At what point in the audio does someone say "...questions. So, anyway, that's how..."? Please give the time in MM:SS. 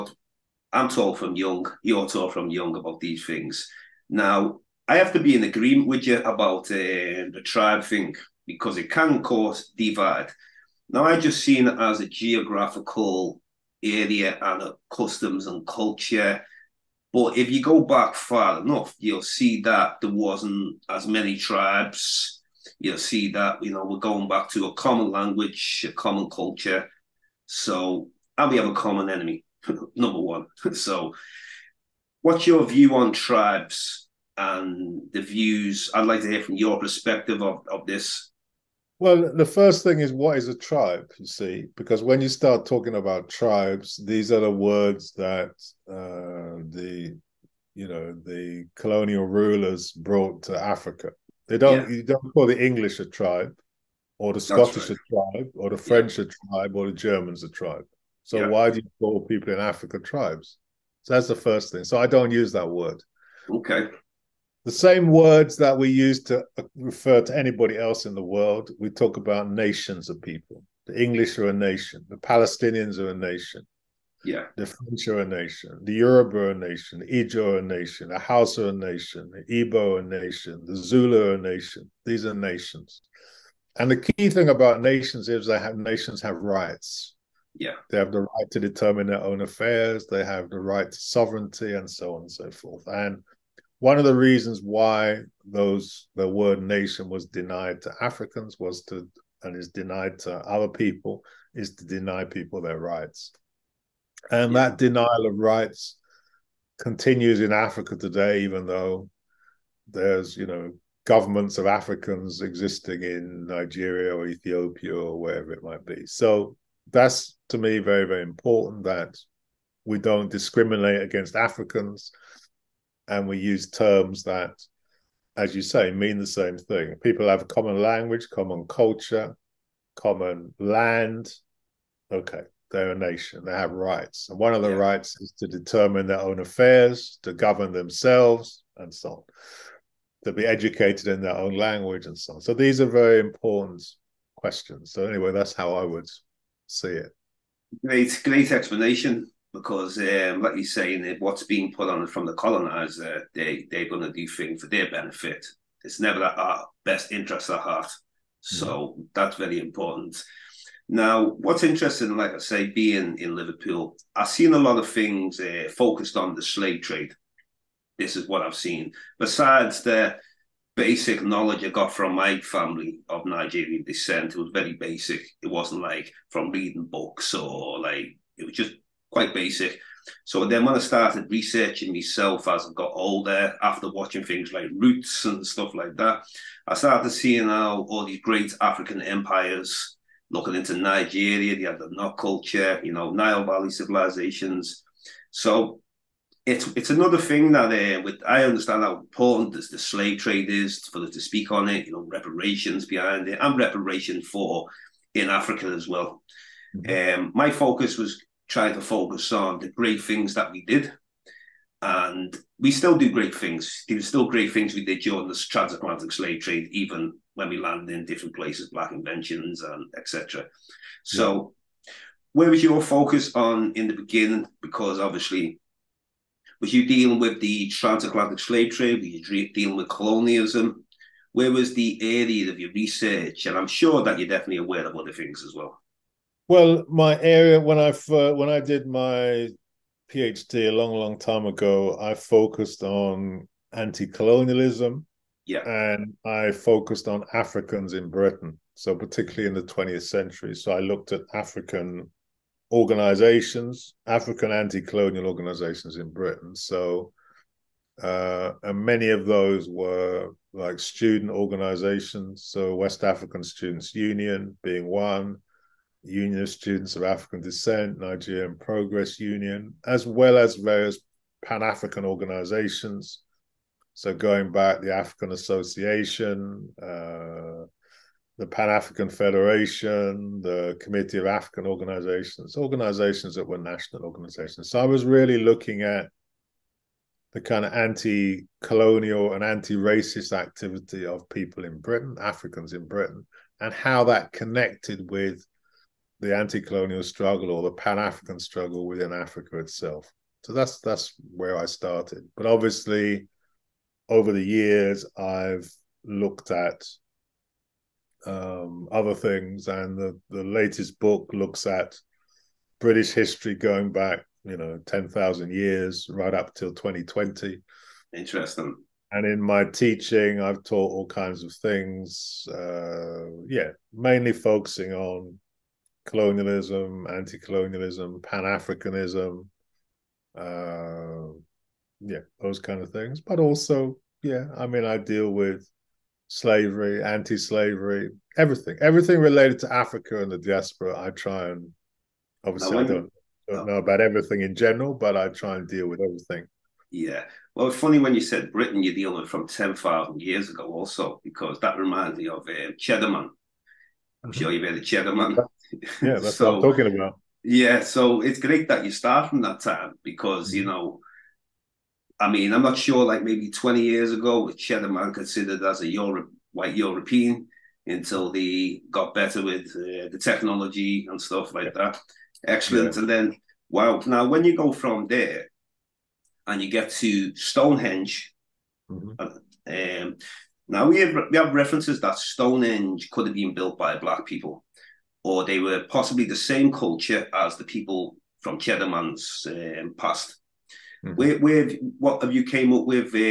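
02:24.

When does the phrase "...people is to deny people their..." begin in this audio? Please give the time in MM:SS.
01:40.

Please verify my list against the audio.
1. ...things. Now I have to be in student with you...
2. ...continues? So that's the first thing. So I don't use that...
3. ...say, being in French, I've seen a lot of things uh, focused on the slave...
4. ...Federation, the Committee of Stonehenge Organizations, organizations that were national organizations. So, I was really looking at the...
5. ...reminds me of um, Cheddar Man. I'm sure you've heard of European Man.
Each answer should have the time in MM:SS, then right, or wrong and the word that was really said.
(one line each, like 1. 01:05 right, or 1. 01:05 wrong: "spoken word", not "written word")
1. 00:03 wrong: "agreement", not "student"
2. 00:59 wrong: "tribes", not "continues"
3. 02:42 wrong: "Liverpool", not "French"
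4. 04:39 wrong: "African", not "Stonehenge"
5. 05:51 wrong: "Cheddar", not "European".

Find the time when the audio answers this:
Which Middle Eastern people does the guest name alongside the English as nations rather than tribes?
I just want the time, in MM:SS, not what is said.
01:12.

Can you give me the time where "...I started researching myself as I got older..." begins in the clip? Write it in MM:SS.
03:00.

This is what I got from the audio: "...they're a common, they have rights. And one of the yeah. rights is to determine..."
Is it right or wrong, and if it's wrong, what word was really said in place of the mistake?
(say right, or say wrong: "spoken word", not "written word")
wrong: "nation", not "common".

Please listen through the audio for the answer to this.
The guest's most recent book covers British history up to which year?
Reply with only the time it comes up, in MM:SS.
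05:16.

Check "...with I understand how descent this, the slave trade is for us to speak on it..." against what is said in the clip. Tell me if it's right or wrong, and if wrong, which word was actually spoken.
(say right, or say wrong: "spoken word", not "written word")
wrong: "important", not "descent".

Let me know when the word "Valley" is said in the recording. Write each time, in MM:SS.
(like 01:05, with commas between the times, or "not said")
03:13.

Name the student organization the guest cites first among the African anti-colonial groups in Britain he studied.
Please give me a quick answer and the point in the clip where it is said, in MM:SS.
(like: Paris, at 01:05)
West African Students Union, at 04:22.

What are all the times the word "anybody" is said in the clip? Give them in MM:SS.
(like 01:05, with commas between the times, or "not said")
01:07.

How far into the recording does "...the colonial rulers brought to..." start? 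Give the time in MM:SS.
00:48.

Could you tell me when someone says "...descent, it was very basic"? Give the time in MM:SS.
02:53.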